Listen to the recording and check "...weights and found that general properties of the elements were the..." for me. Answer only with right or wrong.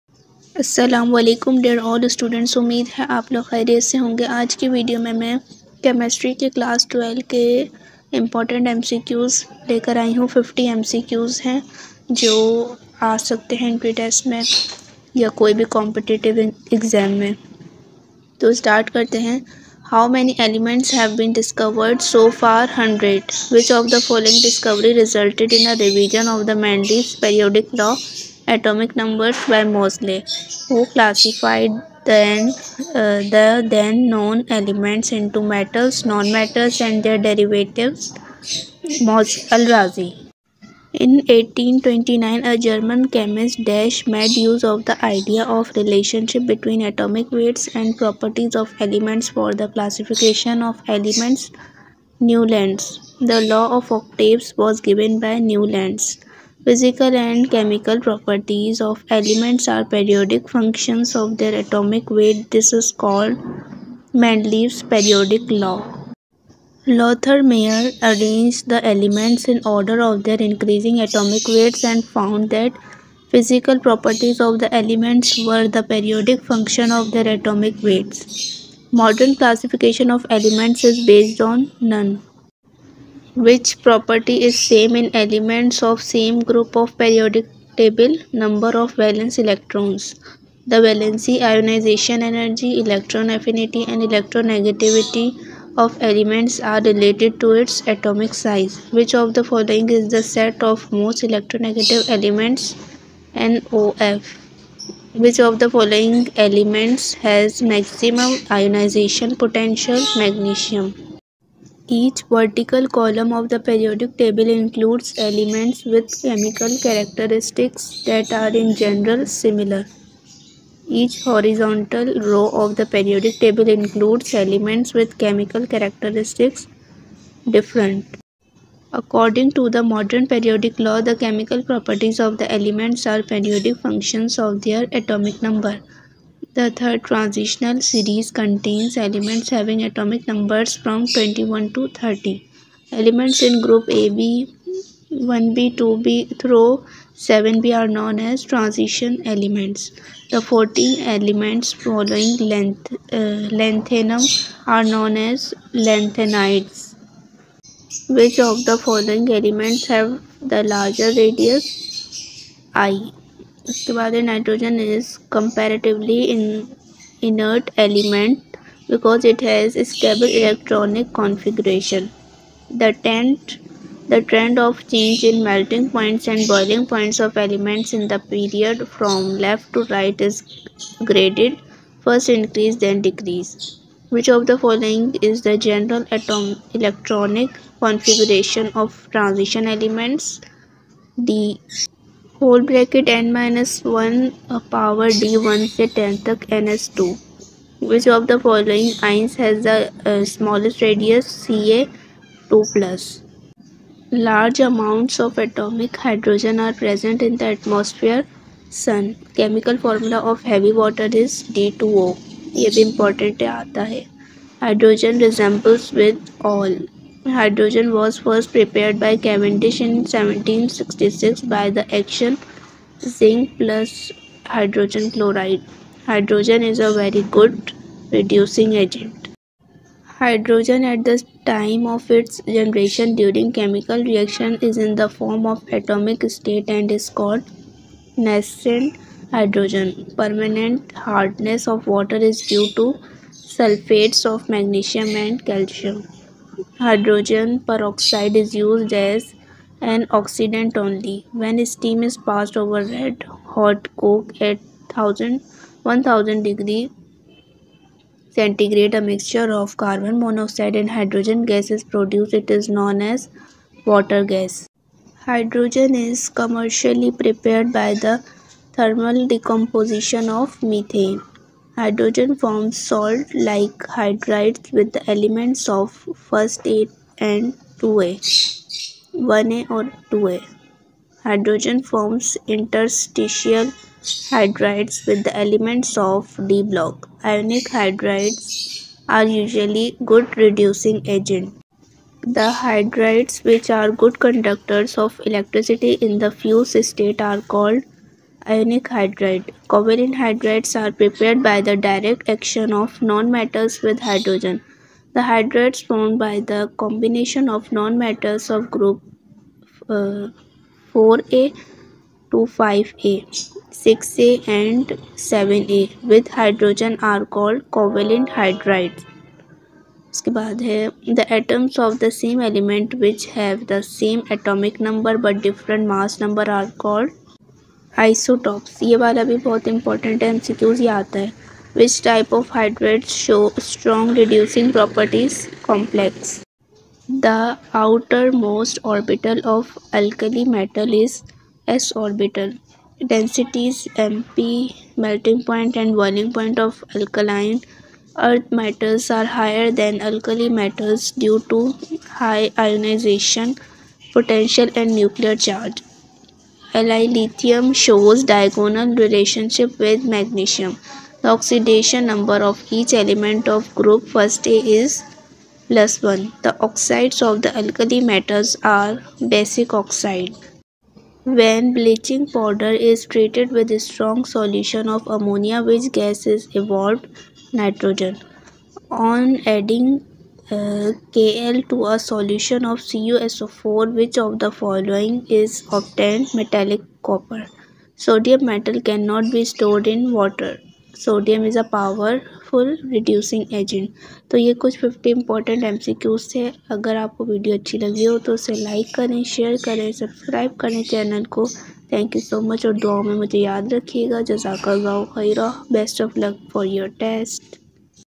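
wrong.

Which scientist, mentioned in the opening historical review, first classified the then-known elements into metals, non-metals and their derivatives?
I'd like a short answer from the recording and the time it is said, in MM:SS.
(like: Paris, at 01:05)
Al-Razi, at 00:39.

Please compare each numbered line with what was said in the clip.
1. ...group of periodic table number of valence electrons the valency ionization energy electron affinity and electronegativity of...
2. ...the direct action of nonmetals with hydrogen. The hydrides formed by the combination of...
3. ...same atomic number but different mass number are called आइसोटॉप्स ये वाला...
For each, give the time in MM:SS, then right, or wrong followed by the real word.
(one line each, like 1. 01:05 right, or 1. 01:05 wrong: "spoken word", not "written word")
1. 01:26 right
2. 05:01 right
3. 05:23 right.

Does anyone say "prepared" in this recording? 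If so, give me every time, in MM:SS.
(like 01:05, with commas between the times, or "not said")
03:38, 04:27, 05:00.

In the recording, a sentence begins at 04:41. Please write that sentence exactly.
Hydrogen forms interstitial hydrides with the elements of D block.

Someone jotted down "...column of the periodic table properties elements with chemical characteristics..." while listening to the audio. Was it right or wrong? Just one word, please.
wrong.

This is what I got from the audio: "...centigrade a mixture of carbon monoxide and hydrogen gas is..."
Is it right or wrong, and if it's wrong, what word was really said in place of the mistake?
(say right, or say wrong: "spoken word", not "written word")
right.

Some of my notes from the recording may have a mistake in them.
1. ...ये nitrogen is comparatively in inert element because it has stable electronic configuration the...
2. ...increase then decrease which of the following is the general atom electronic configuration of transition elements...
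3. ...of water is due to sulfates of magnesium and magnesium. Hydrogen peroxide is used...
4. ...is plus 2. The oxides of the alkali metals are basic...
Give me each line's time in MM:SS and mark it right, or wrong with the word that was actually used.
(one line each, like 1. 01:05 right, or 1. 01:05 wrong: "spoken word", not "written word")
1. 02:44 right
2. 03:02 right
3. 04:01 wrong: "calcium", not "magnesium"
4. 06:04 wrong: "1", not "2".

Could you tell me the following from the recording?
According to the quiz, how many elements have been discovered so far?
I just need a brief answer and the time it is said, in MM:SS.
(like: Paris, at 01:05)
100, at 00:22.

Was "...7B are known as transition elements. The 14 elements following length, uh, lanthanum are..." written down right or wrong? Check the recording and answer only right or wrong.
right.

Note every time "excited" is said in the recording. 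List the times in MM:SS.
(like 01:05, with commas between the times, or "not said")
not said.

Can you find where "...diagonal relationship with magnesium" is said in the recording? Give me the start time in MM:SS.
05:58.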